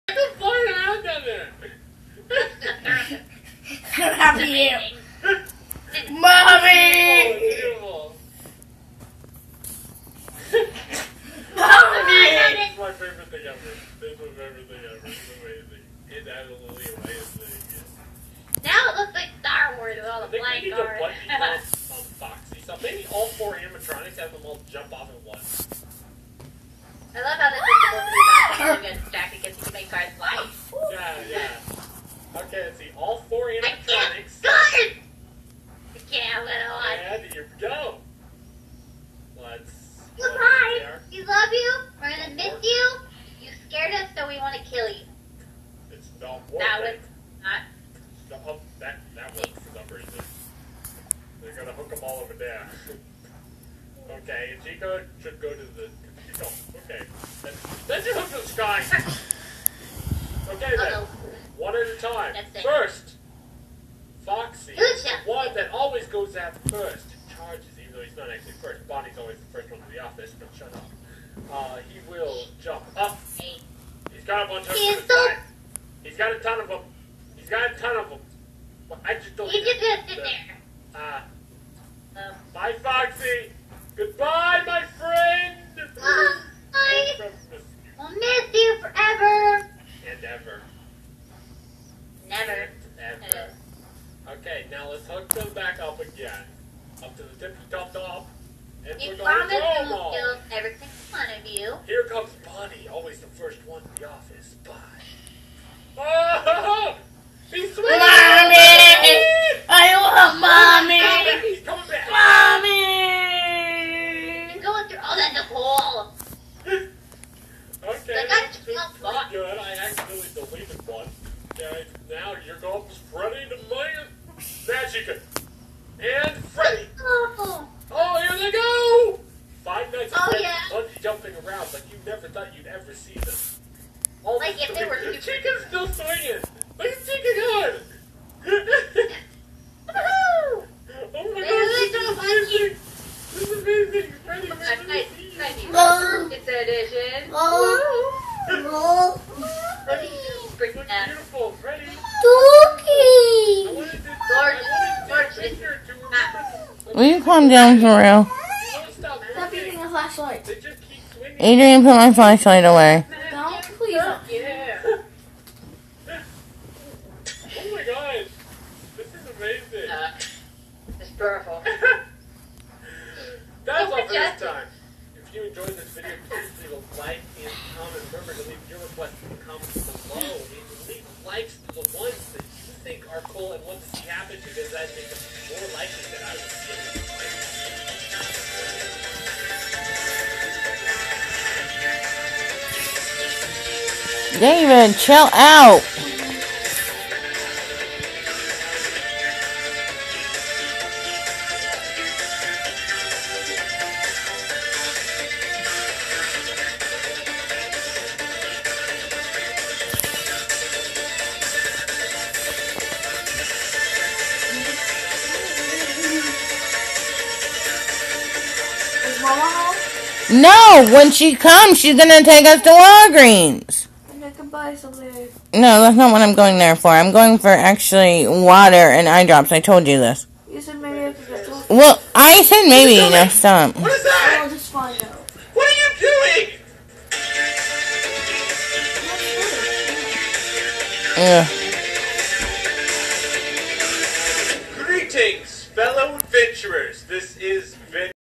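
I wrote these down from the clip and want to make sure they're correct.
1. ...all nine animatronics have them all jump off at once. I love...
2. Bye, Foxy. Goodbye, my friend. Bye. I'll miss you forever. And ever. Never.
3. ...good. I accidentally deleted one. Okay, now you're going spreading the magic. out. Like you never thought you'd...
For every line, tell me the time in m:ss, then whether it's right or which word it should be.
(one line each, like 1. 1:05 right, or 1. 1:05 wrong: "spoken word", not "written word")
1. 0:23 wrong: "four", not "nine"
2. 1:22 right
3. 1:59 right.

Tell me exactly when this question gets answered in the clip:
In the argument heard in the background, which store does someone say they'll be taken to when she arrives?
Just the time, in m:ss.
3:42.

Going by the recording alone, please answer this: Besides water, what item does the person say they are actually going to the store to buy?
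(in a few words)
Eye drops.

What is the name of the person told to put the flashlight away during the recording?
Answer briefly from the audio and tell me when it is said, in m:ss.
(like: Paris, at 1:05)
Adrian, at 2:41.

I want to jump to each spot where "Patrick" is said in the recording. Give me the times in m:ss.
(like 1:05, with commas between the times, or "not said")
not said.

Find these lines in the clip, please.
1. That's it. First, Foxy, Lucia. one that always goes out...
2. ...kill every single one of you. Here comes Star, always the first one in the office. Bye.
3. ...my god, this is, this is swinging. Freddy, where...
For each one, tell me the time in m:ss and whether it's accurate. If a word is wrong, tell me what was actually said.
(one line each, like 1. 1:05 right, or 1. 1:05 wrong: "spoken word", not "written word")
1. 1:02 right
2. 1:40 wrong: "Bonnie", not "Star"
3. 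2:21 wrong: "amazing", not "swinging".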